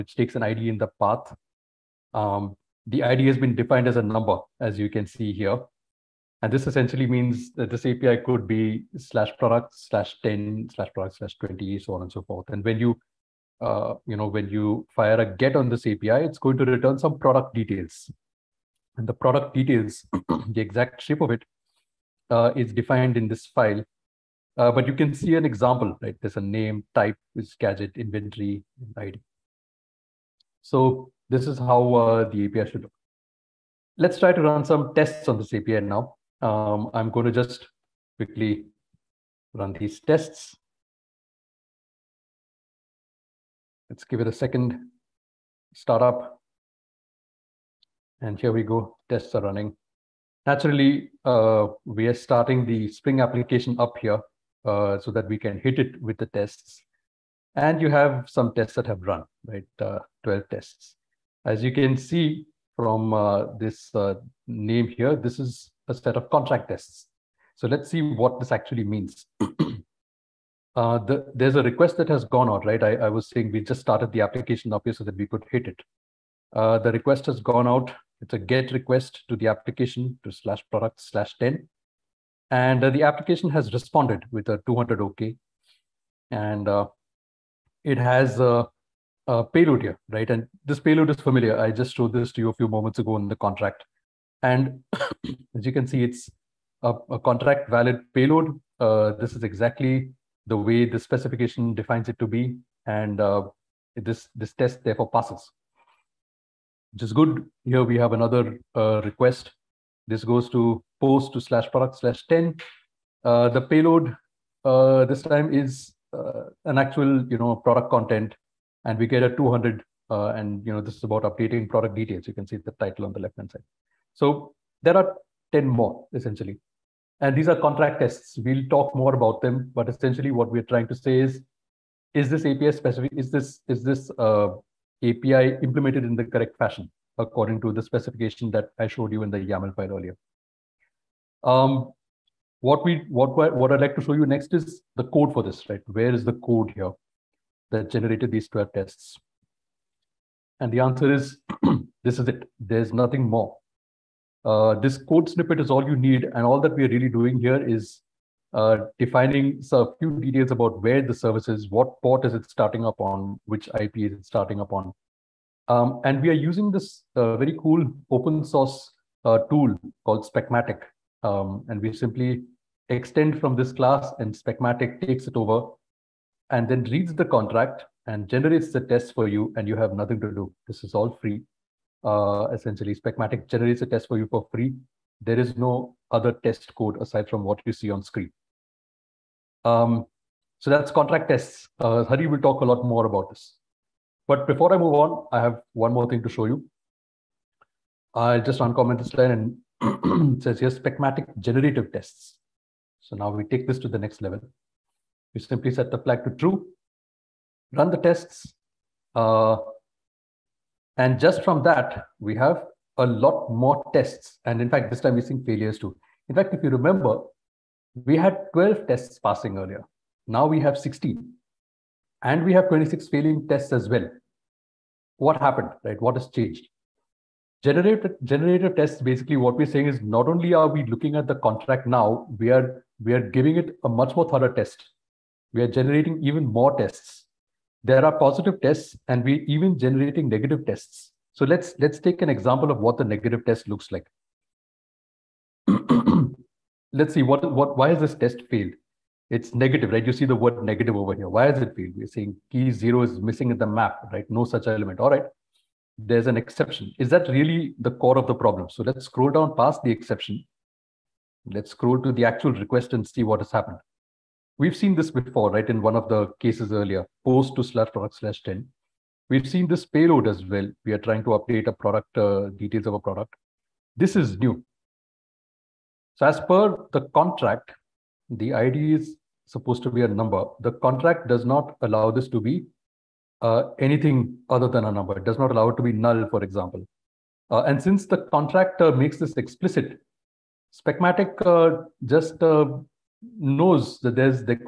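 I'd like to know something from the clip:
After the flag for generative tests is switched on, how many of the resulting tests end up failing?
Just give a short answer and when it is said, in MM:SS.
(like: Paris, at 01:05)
26, at 03:42.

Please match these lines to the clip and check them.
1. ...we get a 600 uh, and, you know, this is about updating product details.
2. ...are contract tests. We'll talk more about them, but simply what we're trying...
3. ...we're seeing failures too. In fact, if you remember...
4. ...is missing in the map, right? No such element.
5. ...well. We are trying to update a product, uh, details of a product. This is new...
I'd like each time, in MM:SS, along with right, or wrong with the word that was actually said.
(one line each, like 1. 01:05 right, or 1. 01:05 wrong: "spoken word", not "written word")
1. 01:58 wrong: "200", not "600"
2. 02:07 wrong: "essentially", not "simply"
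3. 03:35 right
4. 04:13 right
5. 04:30 right.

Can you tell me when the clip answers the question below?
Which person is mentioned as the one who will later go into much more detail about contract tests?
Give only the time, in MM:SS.
03:12.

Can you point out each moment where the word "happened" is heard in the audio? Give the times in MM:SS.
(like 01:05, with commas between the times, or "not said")
03:45, 04:23.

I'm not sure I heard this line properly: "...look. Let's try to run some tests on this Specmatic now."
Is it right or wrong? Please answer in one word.
wrong.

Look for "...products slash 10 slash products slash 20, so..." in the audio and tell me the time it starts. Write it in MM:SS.
00:09.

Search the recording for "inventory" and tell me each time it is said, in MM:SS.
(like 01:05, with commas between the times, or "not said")
00:27.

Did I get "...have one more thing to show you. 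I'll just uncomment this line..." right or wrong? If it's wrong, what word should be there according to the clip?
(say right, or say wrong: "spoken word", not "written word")
right.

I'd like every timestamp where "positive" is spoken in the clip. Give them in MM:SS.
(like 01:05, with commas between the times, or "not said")
03:58.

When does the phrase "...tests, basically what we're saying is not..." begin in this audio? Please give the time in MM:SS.
03:48.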